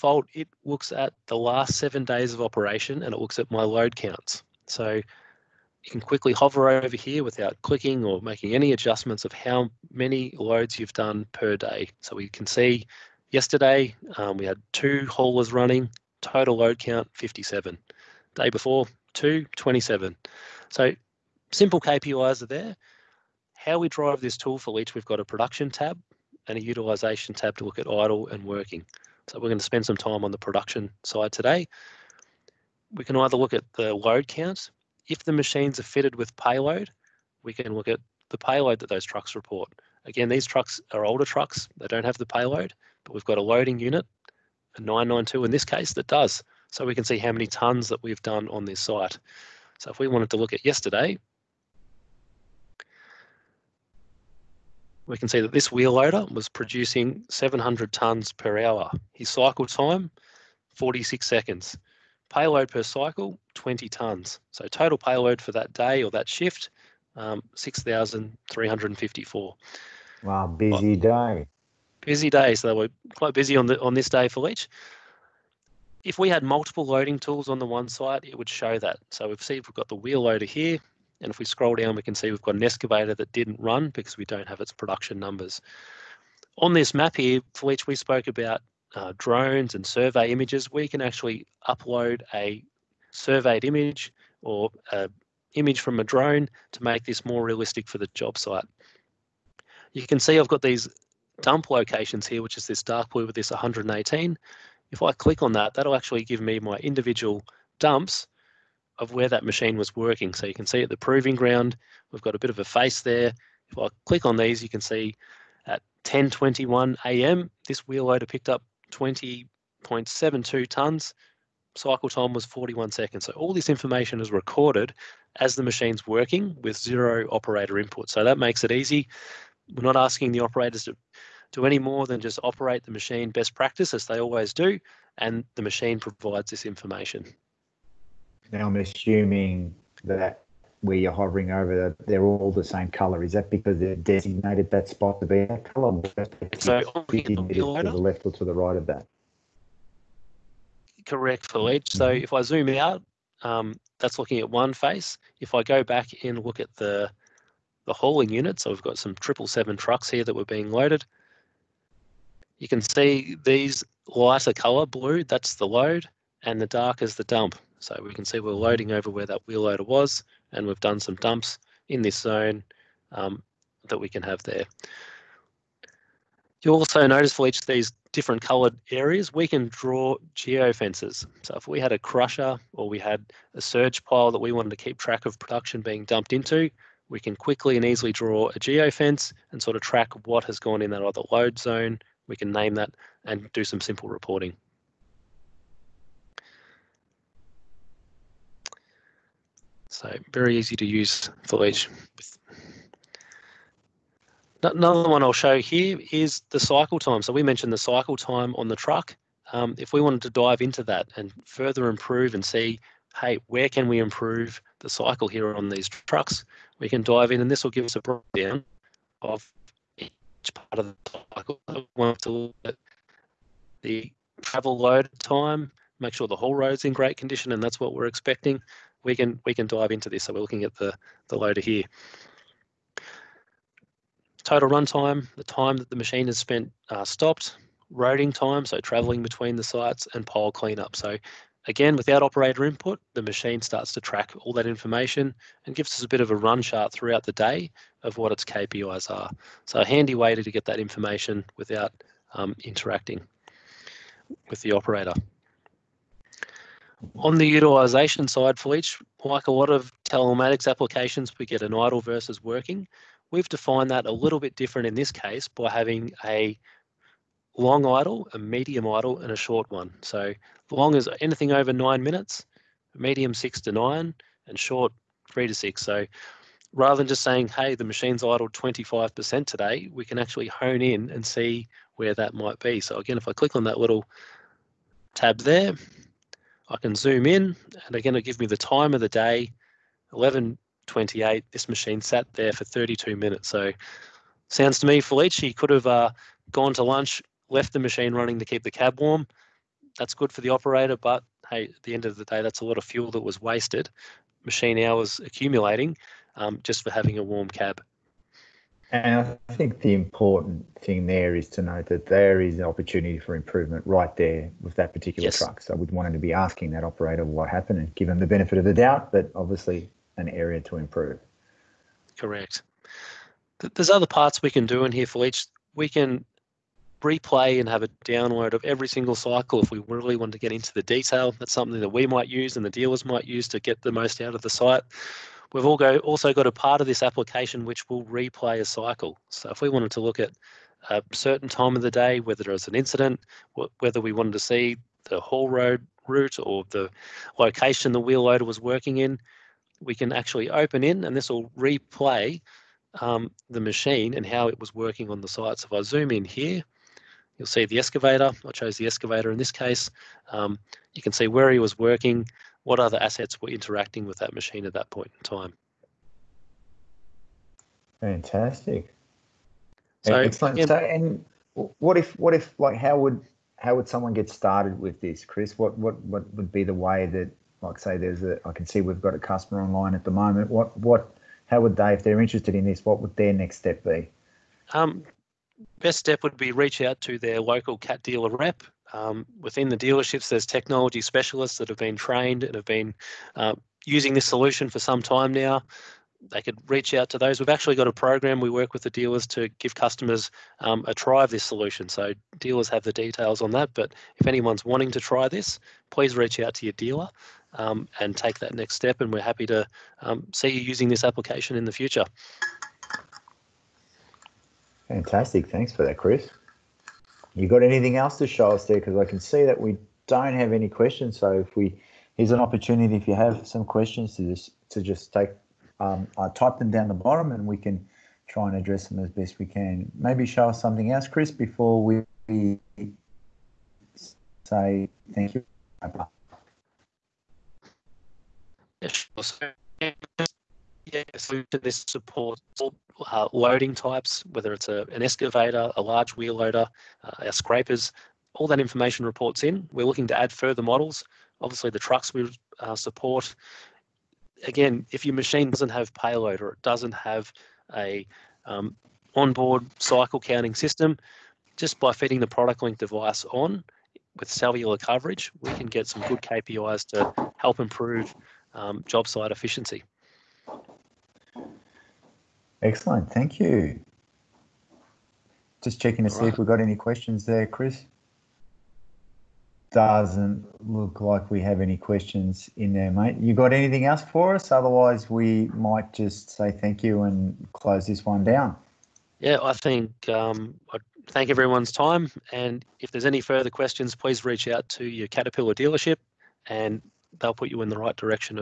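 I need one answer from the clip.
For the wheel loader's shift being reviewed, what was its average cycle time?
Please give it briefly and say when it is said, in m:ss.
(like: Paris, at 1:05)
46 seconds, at 1:00.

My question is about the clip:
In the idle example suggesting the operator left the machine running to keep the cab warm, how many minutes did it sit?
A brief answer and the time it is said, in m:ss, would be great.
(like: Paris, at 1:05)
32 minutes, at 4:52.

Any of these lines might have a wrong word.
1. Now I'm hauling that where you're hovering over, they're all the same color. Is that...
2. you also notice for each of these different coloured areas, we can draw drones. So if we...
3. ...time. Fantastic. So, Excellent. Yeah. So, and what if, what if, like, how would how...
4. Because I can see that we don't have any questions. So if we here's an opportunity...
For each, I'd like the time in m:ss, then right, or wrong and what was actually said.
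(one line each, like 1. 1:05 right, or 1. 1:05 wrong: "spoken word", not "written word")
1. 2:18 wrong: "assuming", not "hauling"
2. 2:56 wrong: "geofences", not "drones"
3. 6:05 right
4. 6:58 right.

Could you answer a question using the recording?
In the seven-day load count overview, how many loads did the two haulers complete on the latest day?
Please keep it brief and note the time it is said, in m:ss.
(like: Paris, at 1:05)
57, at 0:16.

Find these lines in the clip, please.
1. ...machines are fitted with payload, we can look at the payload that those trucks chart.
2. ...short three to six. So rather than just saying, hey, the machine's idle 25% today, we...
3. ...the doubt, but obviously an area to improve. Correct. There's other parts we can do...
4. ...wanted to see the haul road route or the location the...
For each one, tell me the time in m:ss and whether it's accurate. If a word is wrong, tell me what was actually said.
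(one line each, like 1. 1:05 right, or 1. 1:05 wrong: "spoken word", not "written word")
1. 0:35 wrong: "report", not "chart"
2. 4:34 right
3. 5:18 right
4. 5:44 right.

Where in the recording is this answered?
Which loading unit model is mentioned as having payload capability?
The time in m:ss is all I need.
0:44.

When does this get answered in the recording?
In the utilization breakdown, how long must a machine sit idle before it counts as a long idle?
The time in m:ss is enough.
4:31.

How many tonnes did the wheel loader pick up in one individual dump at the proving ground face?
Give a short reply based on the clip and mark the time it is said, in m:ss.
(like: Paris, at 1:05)
20.72 tonnes, at 1:58.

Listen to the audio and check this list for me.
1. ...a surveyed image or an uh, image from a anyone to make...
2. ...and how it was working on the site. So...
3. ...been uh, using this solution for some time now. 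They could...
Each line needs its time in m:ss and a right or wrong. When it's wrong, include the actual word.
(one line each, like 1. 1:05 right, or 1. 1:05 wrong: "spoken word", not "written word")
1. 1:32 wrong: "drone", not "anyone"
2. 5:54 right
3. 6:32 right.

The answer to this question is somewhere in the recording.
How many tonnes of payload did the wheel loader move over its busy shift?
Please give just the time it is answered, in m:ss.
1:07.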